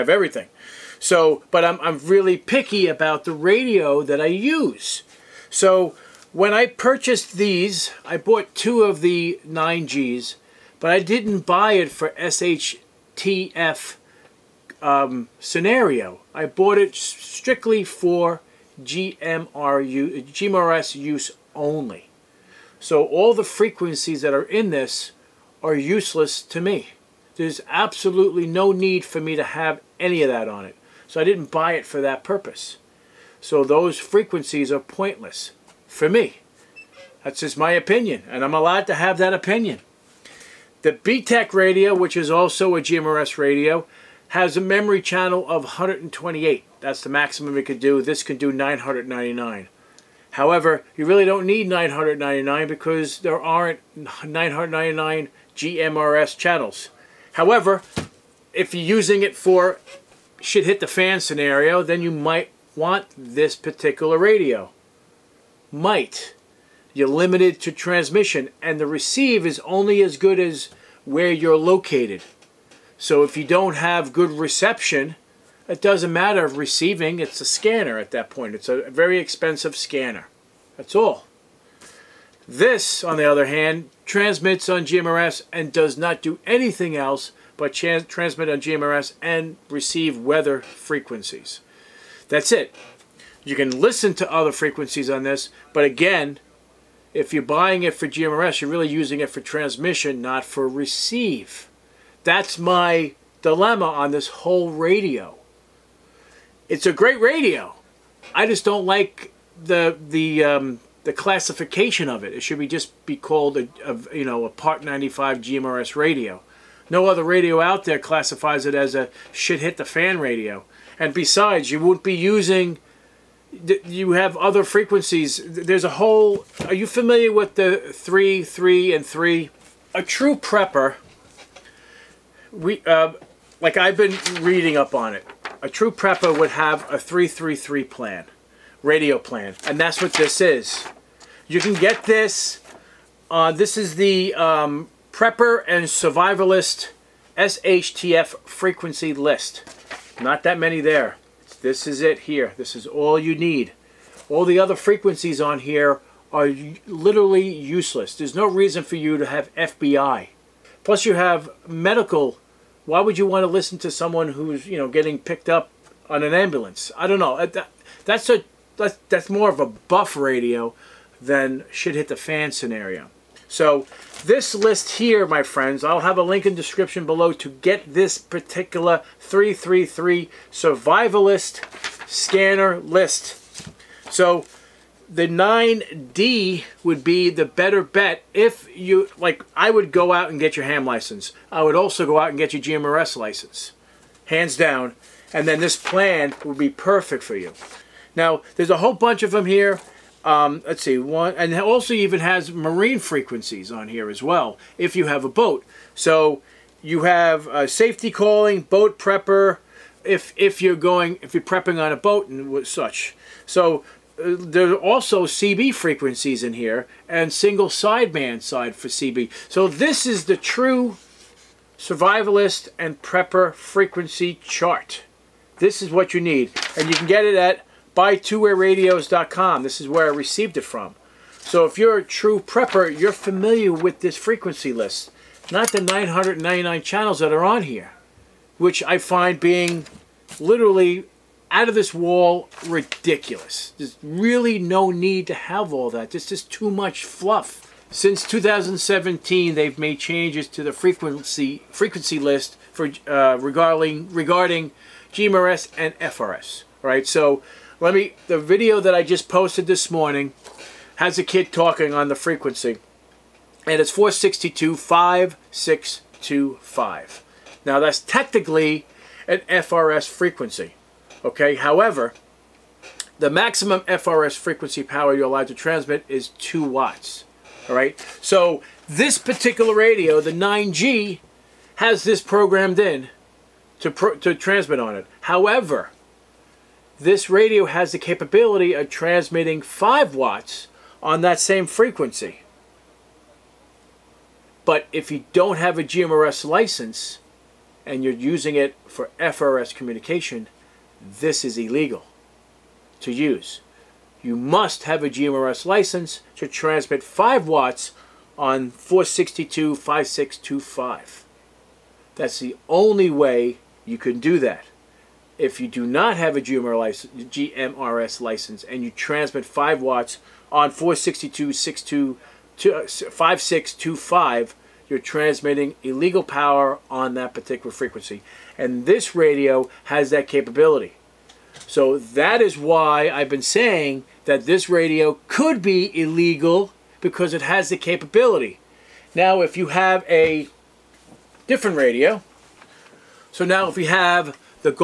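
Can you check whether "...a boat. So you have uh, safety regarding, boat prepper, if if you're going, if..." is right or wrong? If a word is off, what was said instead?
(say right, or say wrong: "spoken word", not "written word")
wrong: "calling", not "regarding".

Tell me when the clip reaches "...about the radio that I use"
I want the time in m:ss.
0:02.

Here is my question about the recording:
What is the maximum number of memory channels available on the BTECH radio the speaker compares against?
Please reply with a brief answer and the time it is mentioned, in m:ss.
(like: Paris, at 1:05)
128, at 0:45.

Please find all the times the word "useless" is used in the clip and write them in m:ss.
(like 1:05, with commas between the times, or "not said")
0:25, 2:37.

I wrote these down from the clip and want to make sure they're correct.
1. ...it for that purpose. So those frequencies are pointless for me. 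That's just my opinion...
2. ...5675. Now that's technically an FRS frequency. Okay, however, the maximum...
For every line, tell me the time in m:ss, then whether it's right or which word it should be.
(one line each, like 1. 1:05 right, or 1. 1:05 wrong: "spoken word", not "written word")
1. 0:31 right
2. 4:24 wrong: "5625", not "5675".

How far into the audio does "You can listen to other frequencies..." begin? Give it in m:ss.
1:33.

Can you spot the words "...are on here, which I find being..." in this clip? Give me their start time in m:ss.
3:57.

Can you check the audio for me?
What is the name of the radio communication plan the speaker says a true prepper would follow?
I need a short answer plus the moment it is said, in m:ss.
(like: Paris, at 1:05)
333 plan, at 2:16.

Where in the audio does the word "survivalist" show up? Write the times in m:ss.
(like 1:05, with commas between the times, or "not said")
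2:25, 3:00, 3:41.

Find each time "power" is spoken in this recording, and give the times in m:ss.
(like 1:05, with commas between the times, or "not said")
4:34, 5:26.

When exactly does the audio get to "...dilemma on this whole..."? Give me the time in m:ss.
1:43.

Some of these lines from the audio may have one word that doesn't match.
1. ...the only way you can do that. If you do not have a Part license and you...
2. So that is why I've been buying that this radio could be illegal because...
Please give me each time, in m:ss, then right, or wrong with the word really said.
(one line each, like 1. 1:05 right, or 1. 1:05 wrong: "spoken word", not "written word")
1. 5:12 wrong: "GMRS", not "Part"
2. 5:31 wrong: "saying", not "buying".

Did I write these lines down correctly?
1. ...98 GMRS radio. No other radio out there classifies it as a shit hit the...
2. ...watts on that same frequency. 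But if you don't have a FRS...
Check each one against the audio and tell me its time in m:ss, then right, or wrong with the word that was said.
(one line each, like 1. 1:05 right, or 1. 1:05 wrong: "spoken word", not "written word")
1. 1:54 wrong: "95", not "98"
2. 4:50 wrong: "GMRS", not "FRS".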